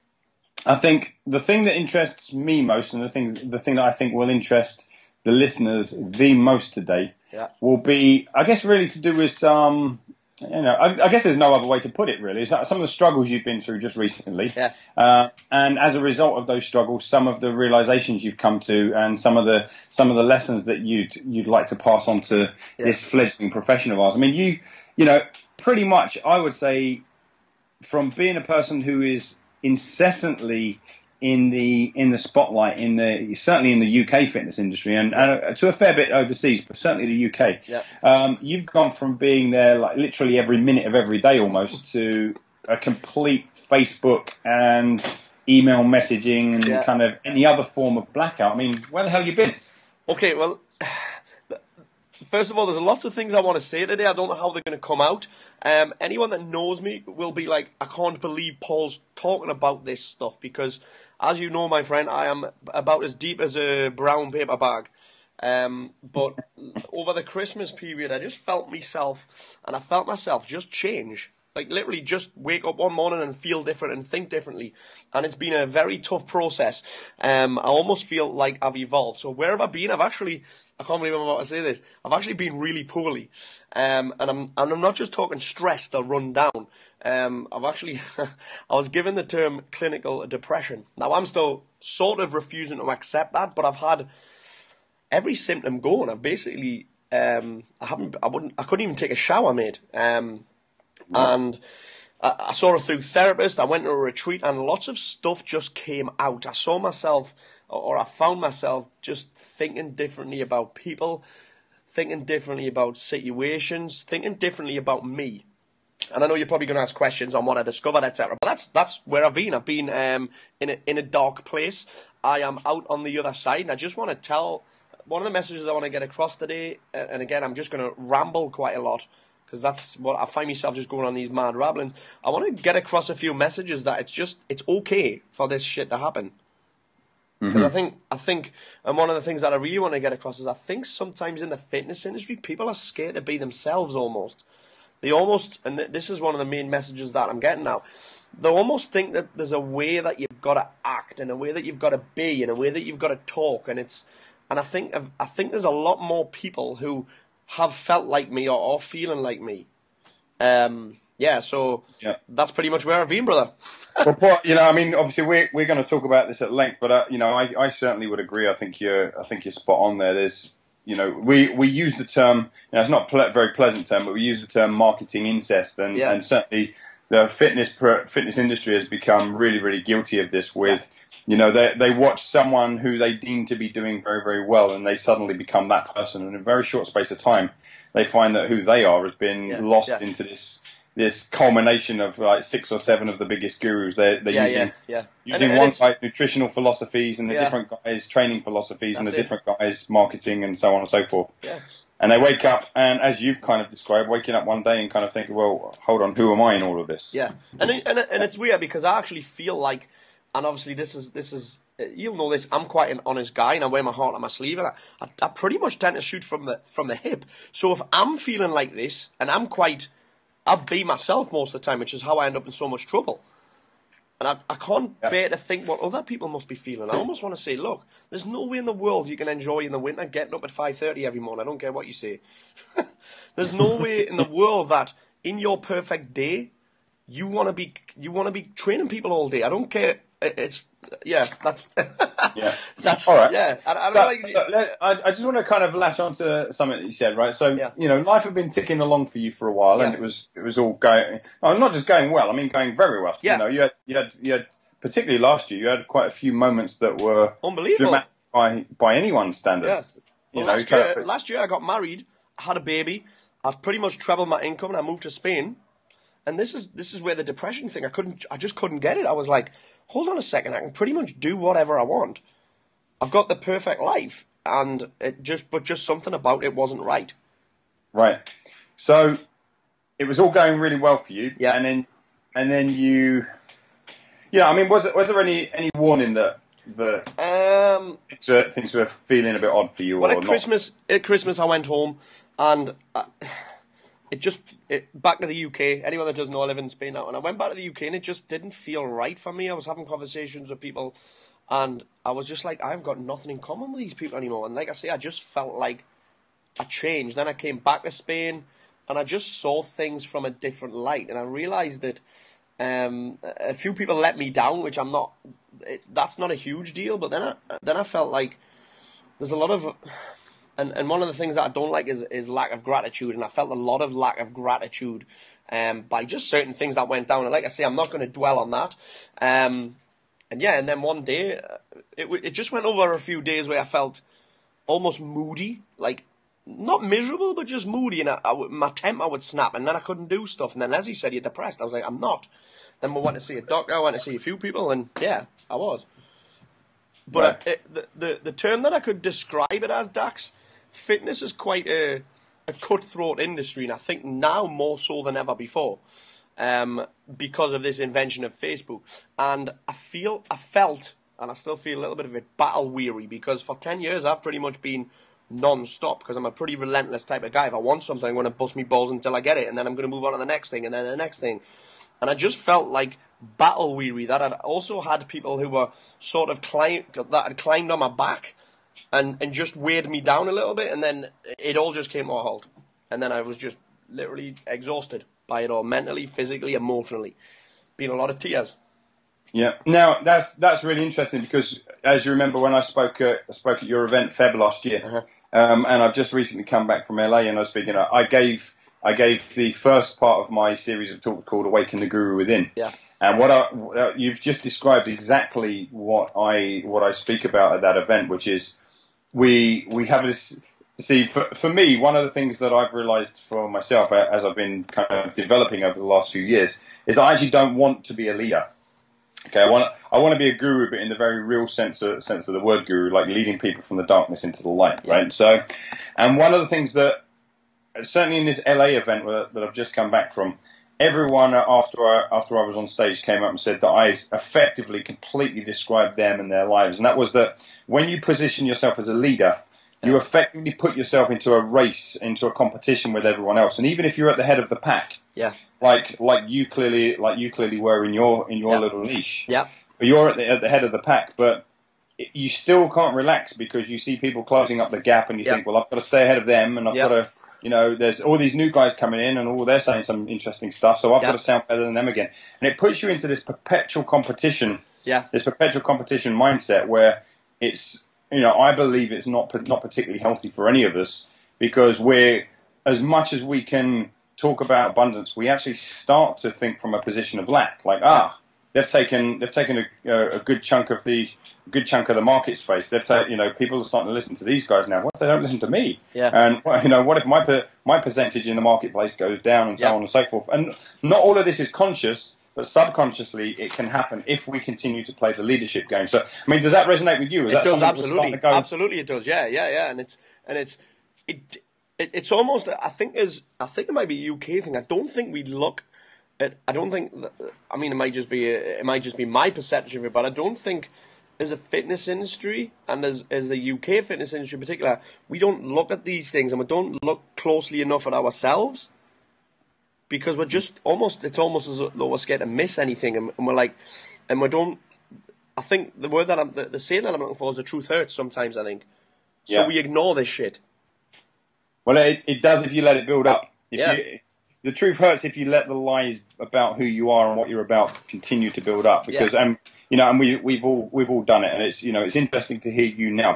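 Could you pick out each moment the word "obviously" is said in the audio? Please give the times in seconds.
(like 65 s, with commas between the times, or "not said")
164 s, 210 s.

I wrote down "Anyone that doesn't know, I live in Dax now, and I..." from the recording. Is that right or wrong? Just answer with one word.
wrong.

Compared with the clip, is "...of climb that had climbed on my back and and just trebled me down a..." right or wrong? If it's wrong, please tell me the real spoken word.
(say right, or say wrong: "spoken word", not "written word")
wrong: "weighed", not "trebled".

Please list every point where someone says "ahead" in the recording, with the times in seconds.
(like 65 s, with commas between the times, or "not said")
456 s.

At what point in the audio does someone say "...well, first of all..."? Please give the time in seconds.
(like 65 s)
50 s.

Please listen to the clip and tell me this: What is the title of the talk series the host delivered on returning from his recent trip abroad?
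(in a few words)
Awaken the Guru Within.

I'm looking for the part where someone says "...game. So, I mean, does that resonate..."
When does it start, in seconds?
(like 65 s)
495 s.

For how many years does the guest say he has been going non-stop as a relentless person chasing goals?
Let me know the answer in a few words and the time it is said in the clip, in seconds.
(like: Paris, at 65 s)
10, at 363 s.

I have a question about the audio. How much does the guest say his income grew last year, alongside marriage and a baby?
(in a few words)
trebled.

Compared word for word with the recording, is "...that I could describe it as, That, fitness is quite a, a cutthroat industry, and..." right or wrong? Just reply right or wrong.
wrong.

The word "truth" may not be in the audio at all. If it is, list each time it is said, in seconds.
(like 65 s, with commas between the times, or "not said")
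527 s, 534 s.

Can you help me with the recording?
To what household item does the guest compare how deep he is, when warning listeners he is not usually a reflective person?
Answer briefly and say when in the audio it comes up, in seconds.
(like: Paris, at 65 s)
brown paper bag, at 63 s.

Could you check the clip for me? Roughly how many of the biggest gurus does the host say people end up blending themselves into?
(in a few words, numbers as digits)
6 or 7.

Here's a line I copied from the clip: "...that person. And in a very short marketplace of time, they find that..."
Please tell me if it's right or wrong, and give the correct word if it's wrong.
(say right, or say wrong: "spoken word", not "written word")
wrong: "space", not "marketplace".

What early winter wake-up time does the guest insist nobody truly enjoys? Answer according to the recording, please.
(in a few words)
5:30.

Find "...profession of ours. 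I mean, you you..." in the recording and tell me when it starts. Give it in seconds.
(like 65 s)
23 s.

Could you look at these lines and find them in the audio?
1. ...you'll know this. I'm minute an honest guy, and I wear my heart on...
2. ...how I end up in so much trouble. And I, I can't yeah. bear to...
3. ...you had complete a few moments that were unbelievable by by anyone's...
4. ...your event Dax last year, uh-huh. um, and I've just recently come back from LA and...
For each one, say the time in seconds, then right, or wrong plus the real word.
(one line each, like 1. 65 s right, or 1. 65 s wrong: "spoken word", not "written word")
1. 211 s wrong: "quite", not "minute"
2. 222 s right
3. 255 s wrong: "quite", not "complete"
4. 393 s wrong: "Feb", not "Dax".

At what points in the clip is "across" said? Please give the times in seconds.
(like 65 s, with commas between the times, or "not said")
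126 s, 132 s, 140 s.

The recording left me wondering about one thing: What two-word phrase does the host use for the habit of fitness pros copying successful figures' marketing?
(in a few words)
marketing incest.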